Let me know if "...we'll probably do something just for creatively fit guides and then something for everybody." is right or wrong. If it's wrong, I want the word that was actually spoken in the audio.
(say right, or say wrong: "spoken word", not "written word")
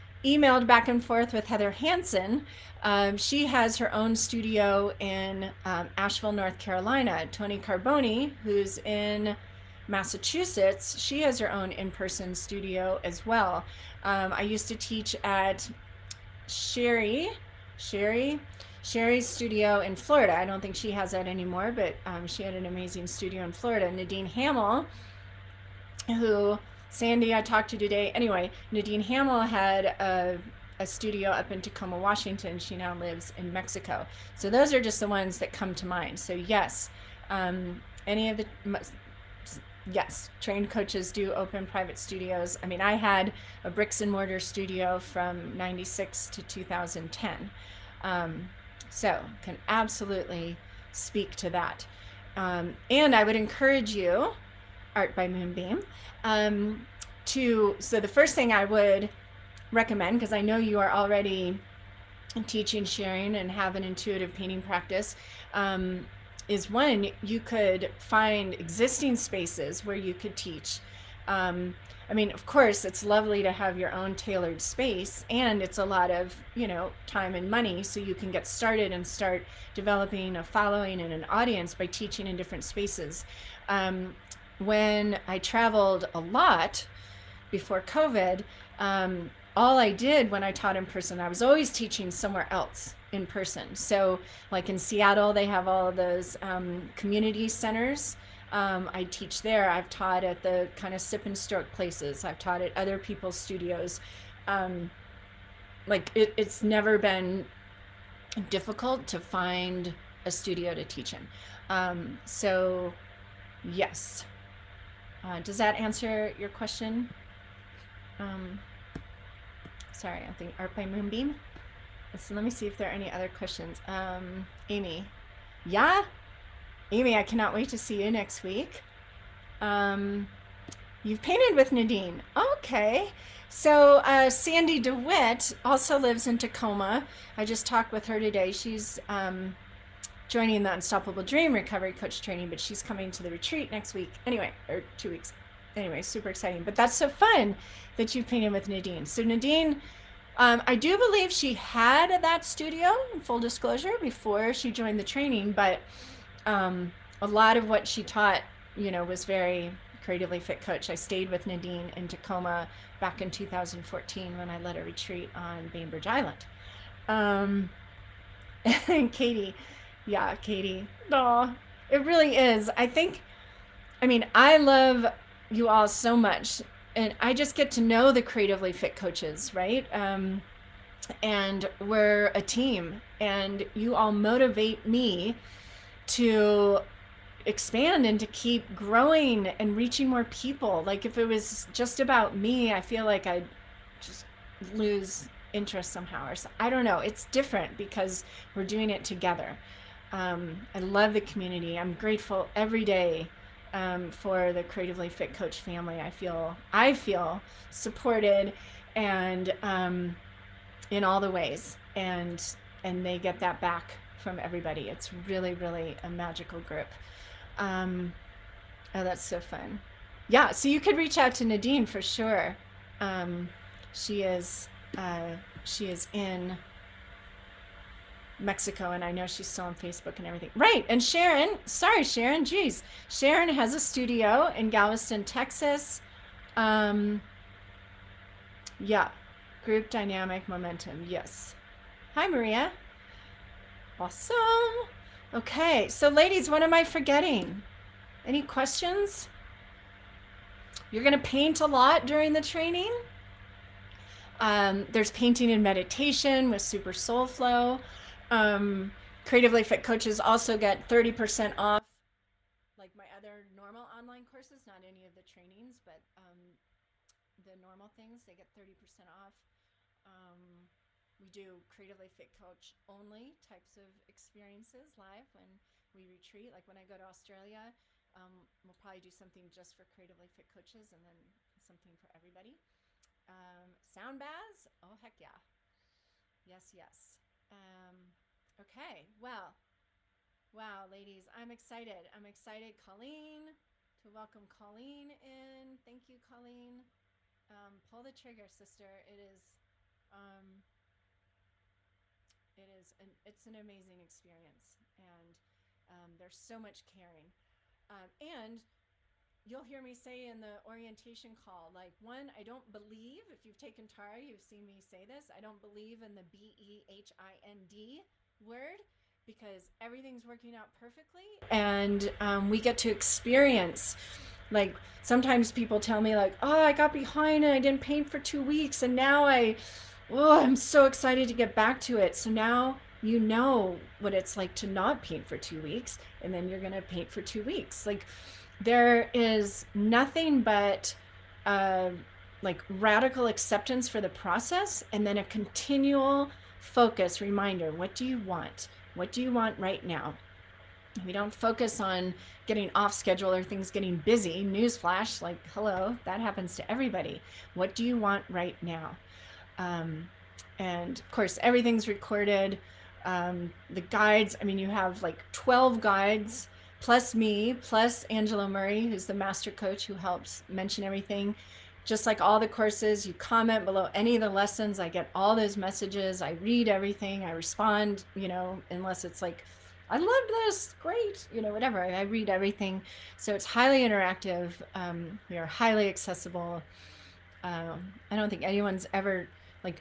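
wrong: "coaches", not "guides".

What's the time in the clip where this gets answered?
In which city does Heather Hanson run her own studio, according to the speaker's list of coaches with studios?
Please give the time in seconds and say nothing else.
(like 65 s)
5 s.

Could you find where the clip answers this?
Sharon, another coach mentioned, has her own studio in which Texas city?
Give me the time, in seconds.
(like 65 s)
234 s.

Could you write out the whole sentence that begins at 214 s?
It's really, really a magical group.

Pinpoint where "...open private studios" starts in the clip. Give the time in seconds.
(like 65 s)
41 s.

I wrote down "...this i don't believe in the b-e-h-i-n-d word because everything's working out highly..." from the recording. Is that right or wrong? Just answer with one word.
wrong.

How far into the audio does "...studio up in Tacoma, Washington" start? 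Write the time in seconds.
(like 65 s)
30 s.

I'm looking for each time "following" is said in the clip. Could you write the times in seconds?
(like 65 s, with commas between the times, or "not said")
80 s.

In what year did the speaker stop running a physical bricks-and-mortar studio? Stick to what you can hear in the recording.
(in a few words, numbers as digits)
2010.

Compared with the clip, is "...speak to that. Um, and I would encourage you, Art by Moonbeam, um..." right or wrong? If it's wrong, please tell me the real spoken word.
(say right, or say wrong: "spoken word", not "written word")
right.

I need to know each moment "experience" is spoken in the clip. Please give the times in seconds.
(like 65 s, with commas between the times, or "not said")
274 s, 304 s, 322 s.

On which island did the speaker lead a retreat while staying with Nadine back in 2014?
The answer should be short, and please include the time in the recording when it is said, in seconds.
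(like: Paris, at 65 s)
Bainbridge Island, at 165 s.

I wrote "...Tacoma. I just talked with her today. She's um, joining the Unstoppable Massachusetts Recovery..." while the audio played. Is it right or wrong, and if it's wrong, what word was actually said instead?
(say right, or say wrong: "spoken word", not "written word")
wrong: "Dream", not "Massachusetts".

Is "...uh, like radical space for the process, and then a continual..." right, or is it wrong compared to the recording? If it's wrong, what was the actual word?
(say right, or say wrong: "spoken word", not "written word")
wrong: "acceptance", not "space".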